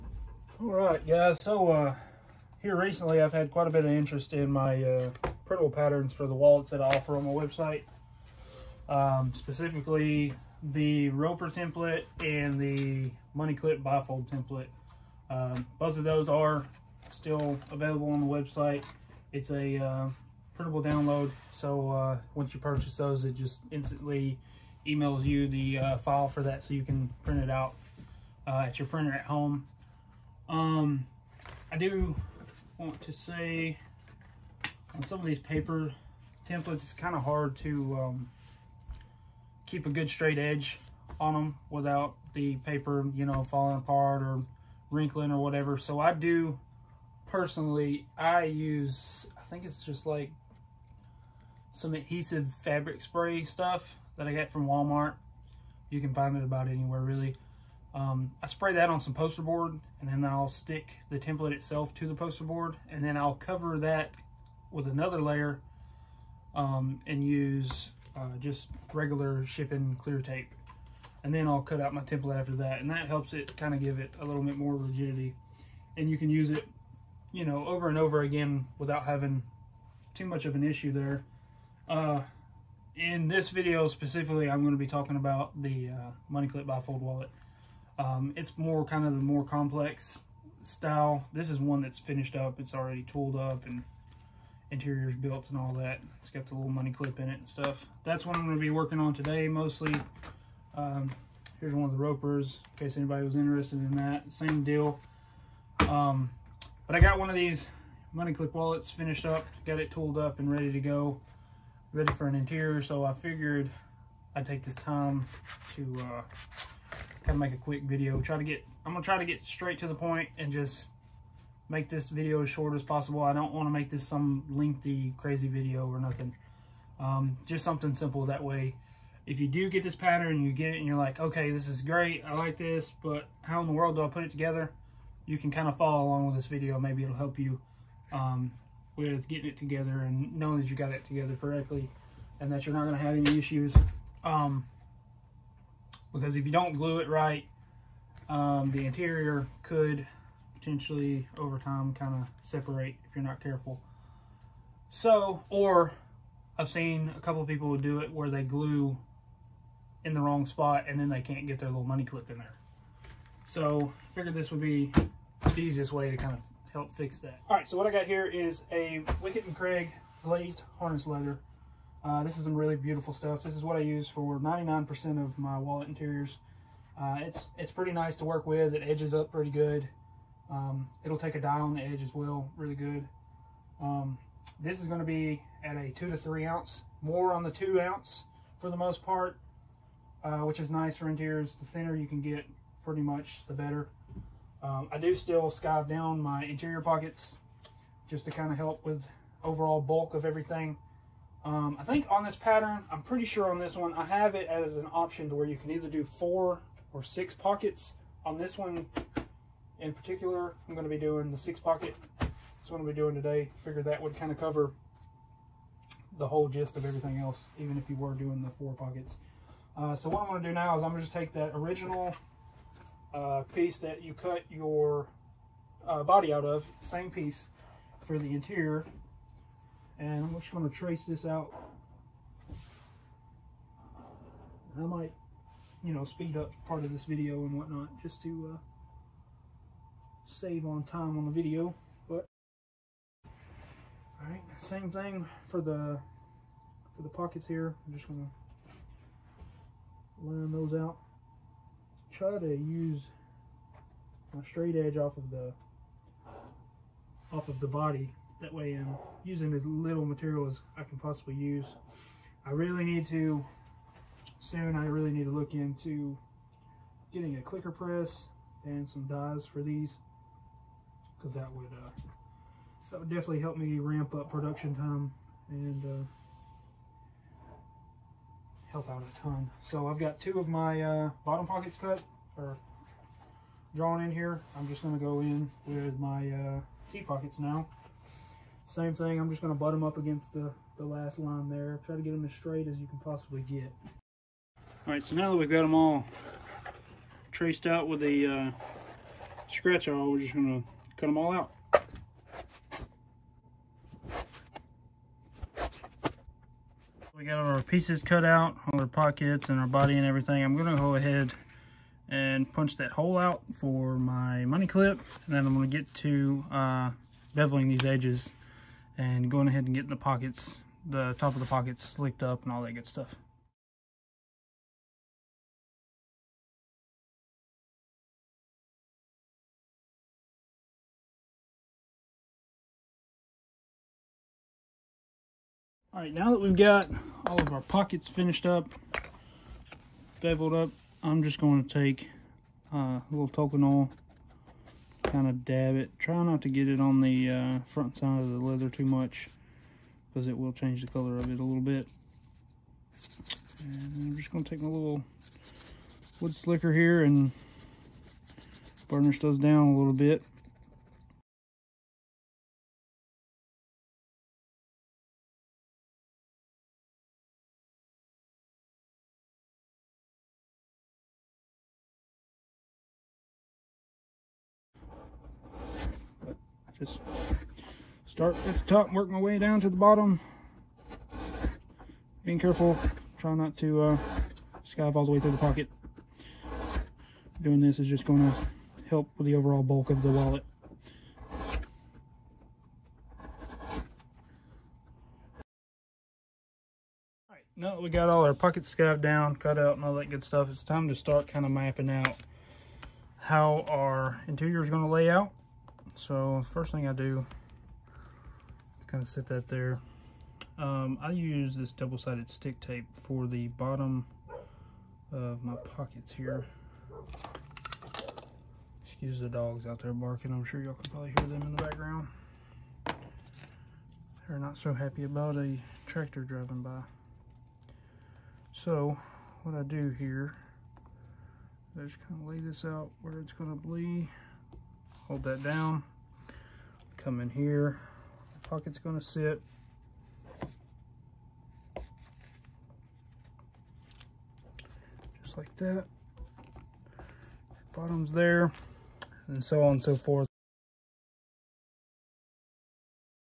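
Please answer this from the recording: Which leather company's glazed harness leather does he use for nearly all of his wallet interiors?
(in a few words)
Wickett and Craig.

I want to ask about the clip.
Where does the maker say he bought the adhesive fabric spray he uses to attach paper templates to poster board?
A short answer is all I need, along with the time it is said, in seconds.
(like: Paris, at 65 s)
Walmart, at 54 s.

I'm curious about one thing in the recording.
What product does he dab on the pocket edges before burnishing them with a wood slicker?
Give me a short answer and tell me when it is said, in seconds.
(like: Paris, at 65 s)
Tokonole, at 343 s.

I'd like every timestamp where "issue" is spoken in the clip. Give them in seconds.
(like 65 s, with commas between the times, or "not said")
80 s, 143 s.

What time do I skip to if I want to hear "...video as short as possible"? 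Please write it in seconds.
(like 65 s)
122 s.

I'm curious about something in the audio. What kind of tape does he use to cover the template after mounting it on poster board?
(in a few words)
shipping clear tape.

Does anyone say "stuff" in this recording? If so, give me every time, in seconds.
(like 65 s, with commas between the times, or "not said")
53 s, 97 s, 173 s, 322 s, 400 s.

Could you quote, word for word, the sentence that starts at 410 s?
Um, I use this double-sided stick tape for the bottom of my pockets here.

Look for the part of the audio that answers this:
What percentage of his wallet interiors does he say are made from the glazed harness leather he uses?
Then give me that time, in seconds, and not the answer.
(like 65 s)
174 s.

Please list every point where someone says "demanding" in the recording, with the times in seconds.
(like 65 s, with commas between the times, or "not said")
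not said.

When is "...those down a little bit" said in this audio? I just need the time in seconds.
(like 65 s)
359 s.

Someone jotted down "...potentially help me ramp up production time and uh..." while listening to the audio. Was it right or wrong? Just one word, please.
wrong.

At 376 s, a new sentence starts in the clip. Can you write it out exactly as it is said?
Just start at the top, work my way down to the bottom.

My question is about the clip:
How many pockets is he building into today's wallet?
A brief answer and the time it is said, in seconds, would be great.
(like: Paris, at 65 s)
6, at 211 s.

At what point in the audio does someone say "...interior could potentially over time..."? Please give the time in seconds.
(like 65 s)
148 s.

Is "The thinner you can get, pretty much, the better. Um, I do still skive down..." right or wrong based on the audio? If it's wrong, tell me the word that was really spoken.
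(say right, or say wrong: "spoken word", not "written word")
right.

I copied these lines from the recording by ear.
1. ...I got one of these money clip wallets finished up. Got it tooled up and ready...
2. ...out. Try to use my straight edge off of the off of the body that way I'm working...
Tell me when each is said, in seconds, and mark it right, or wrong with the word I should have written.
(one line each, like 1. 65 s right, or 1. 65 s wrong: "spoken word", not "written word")
1. 106 s right
2. 250 s wrong: "using", not "working".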